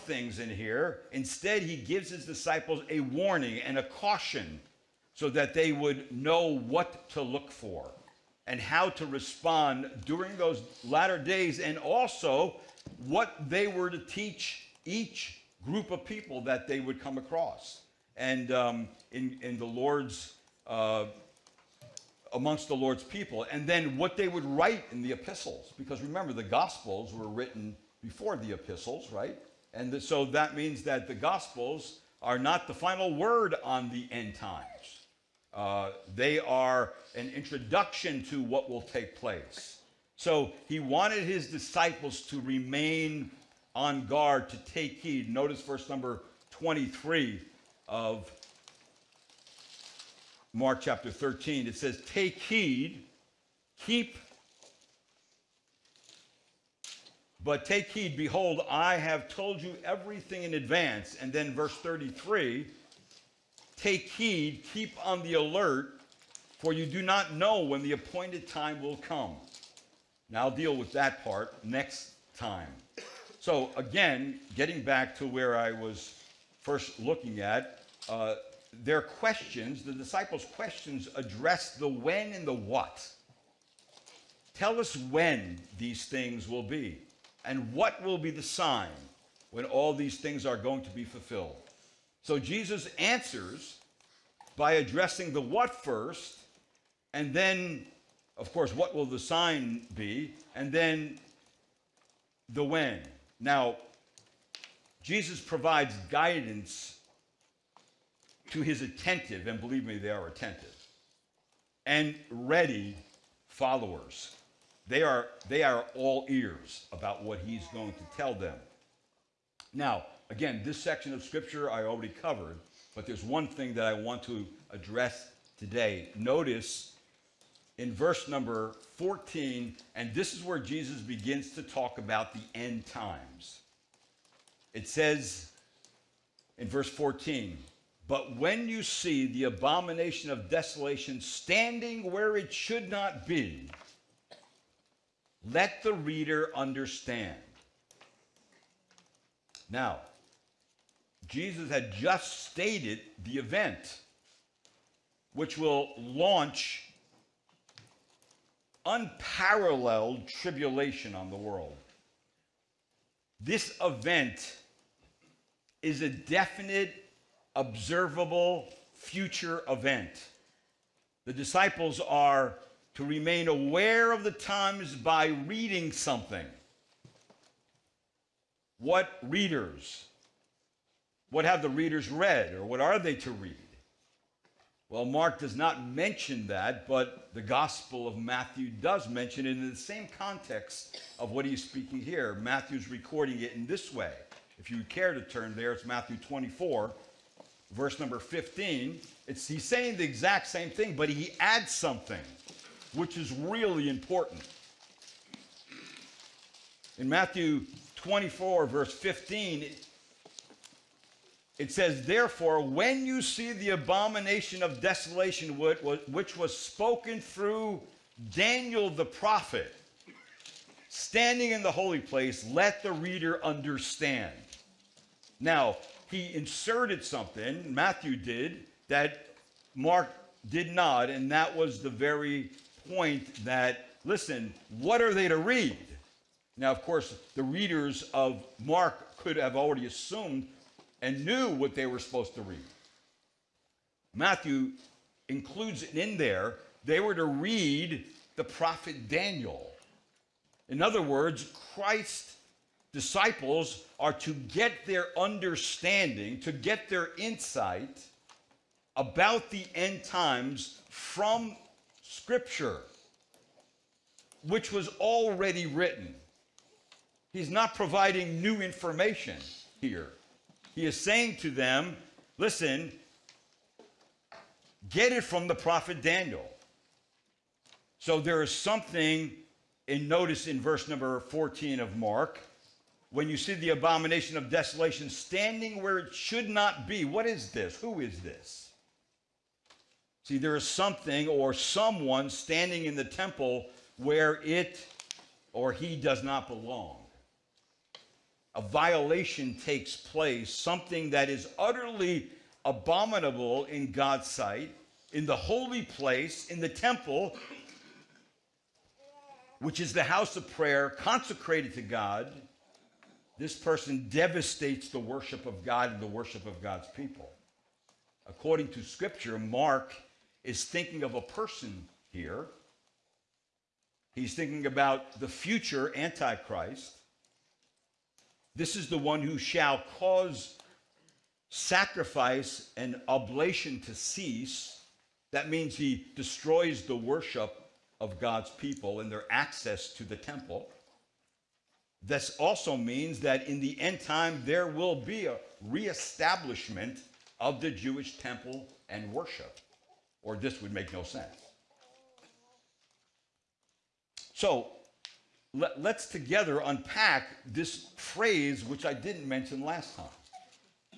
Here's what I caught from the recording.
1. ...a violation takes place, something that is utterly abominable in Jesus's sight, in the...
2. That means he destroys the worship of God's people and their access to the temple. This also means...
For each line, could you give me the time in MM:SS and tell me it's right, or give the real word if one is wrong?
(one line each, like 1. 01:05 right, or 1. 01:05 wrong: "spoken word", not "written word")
1. 04:58 wrong: "God", not "Jesus"
2. 05:35 right.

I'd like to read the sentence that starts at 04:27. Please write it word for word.
He's not providing new information here.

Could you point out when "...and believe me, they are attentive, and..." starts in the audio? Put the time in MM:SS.
01:49.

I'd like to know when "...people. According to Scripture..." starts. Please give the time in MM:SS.
05:16.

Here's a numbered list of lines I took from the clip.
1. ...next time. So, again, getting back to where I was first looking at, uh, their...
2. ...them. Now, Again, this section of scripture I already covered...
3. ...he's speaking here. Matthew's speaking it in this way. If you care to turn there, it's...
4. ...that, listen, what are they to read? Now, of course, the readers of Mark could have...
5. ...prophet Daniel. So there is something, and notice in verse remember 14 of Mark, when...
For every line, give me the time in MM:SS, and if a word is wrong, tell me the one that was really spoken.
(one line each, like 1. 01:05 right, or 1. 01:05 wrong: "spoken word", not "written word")
1. 01:11 right
2. 01:58 right
3. 03:11 wrong: "recording", not "speaking"
4. 03:53 right
5. 04:35 wrong: "number", not "remember".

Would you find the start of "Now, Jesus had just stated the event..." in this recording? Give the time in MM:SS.
02:29.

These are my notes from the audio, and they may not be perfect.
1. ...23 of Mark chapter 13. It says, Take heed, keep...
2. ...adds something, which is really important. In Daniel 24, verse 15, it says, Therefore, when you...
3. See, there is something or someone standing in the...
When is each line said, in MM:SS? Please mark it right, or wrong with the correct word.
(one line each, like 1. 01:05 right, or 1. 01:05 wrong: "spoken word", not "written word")
1. 00:46 right
2. 03:21 wrong: "Matthew", not "Daniel"
3. 04:50 right.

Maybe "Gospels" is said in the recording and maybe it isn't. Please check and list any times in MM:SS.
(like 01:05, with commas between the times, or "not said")
00:26, 00:31, 03:07.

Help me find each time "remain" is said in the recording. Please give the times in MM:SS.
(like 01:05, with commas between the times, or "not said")
00:42, 02:53.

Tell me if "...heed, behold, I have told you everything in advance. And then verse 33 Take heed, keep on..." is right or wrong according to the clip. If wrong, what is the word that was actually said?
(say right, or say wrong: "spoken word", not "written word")
right.